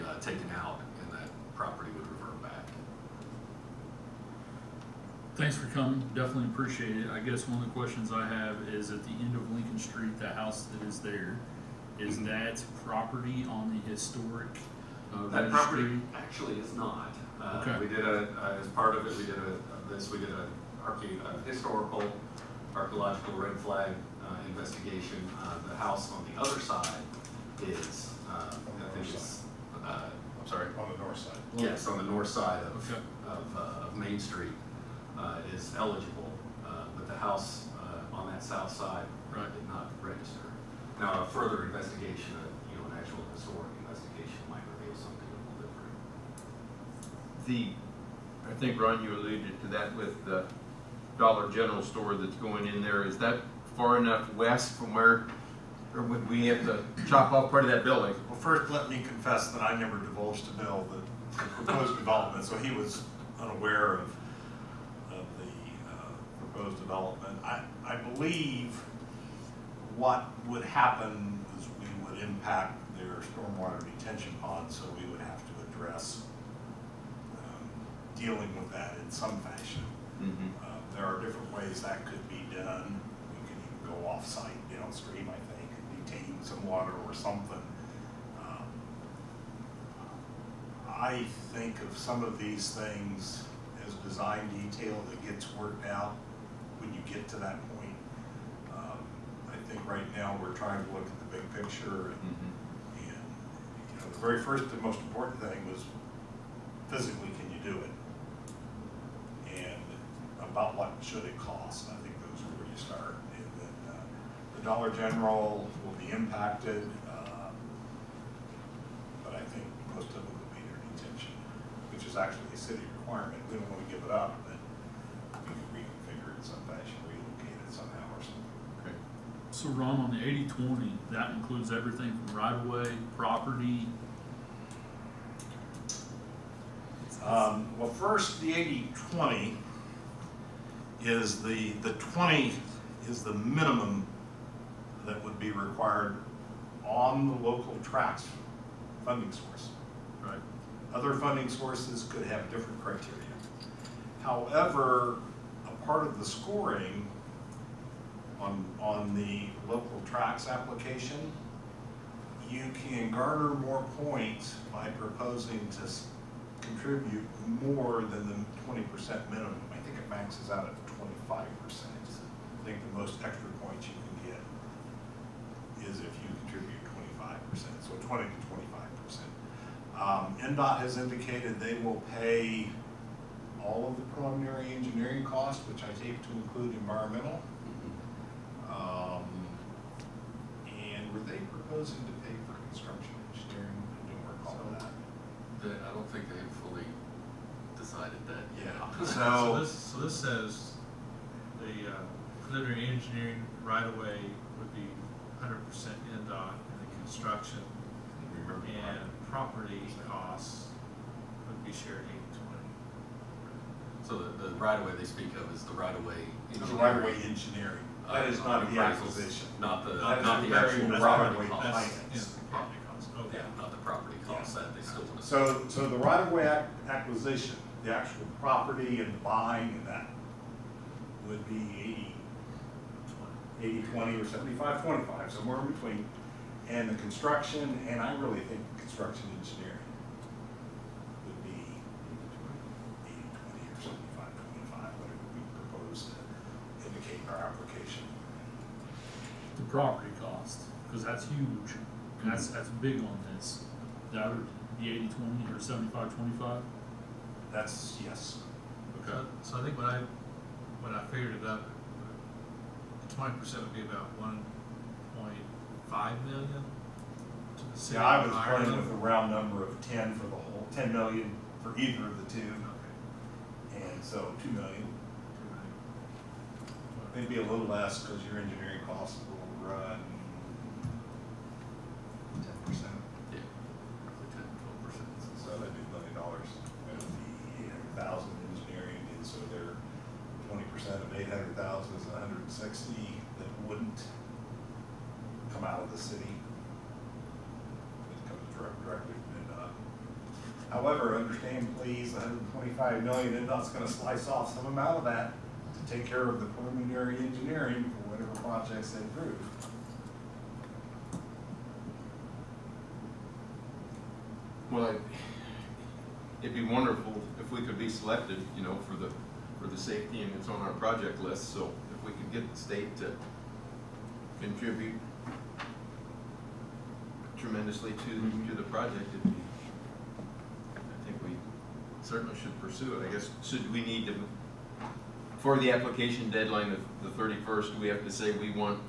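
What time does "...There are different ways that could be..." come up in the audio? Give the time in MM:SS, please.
01:20.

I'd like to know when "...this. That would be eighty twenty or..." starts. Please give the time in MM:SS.
04:13.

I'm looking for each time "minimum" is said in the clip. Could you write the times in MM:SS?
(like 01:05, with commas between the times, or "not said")
02:23, 02:49.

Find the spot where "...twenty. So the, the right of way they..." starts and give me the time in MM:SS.
03:32.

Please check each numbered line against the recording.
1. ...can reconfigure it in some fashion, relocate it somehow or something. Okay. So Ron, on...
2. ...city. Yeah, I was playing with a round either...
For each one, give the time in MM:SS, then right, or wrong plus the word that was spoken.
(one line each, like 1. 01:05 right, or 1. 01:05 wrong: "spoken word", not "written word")
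1. 02:05 right
2. 04:27 wrong: "number", not "either".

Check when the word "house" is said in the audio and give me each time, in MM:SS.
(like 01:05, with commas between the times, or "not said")
00:10, 00:25, 00:37.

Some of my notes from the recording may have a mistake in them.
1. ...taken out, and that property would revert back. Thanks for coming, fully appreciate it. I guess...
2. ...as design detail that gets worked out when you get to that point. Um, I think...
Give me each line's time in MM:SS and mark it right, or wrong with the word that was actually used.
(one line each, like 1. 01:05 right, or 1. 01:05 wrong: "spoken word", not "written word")
1. 00:00 wrong: "definitely", not "fully"
2. 01:33 right.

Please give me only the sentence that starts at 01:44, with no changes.
the very first and most important thing was physically, can you do it?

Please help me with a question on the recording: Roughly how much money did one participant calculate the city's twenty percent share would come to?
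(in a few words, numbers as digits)
$1.5 million.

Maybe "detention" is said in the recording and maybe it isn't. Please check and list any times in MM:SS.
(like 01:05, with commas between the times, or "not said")
01:13, 02:00.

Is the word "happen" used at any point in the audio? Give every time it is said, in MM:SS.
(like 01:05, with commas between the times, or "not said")
01:10.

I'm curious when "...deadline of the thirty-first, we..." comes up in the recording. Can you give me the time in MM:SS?
05:36.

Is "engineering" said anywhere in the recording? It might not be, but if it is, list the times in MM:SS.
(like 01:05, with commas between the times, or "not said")
03:04, 03:13, 03:22, 03:37, 03:59, 04:38, 05:07.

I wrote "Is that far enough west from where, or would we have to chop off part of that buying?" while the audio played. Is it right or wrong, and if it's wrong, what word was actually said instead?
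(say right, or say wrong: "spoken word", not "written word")
wrong: "building", not "buying".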